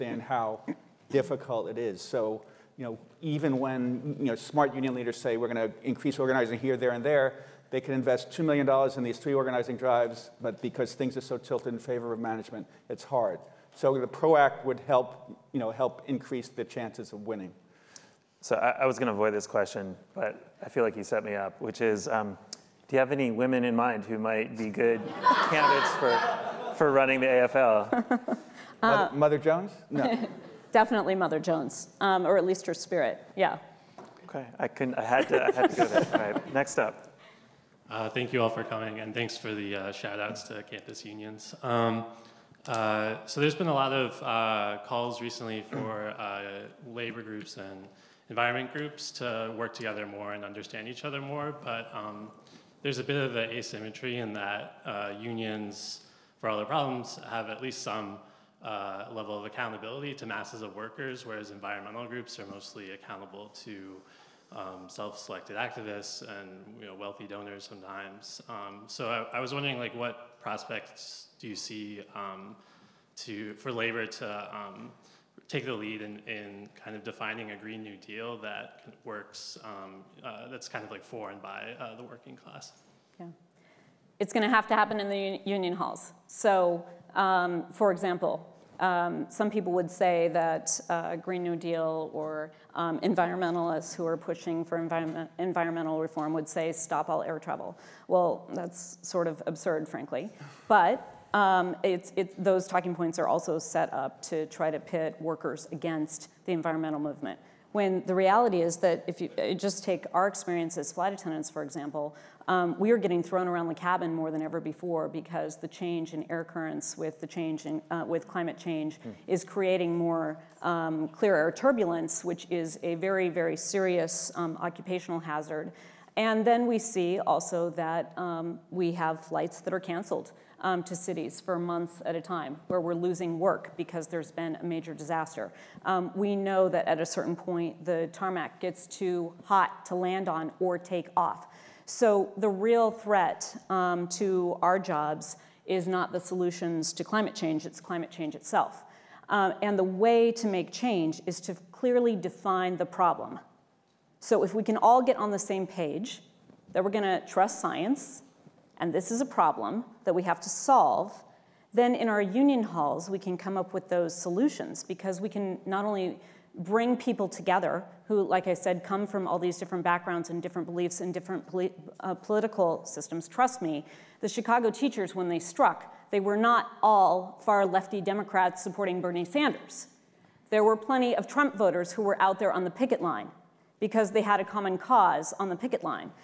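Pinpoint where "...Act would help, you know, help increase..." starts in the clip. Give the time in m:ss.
0:14.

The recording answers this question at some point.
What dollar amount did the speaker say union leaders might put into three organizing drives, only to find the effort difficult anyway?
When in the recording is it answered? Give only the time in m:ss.
0:08.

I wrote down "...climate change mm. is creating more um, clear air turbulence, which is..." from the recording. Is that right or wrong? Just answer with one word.
right.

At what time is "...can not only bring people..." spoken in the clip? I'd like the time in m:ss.
2:45.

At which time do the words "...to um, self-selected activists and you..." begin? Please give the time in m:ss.
1:03.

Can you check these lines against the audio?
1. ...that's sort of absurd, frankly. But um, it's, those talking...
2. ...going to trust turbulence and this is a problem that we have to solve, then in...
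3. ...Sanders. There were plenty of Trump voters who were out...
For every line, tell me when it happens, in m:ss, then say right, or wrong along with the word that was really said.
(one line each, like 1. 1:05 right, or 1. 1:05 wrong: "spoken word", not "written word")
1. 1:38 right
2. 2:36 wrong: "science", not "turbulence"
3. 2:59 right.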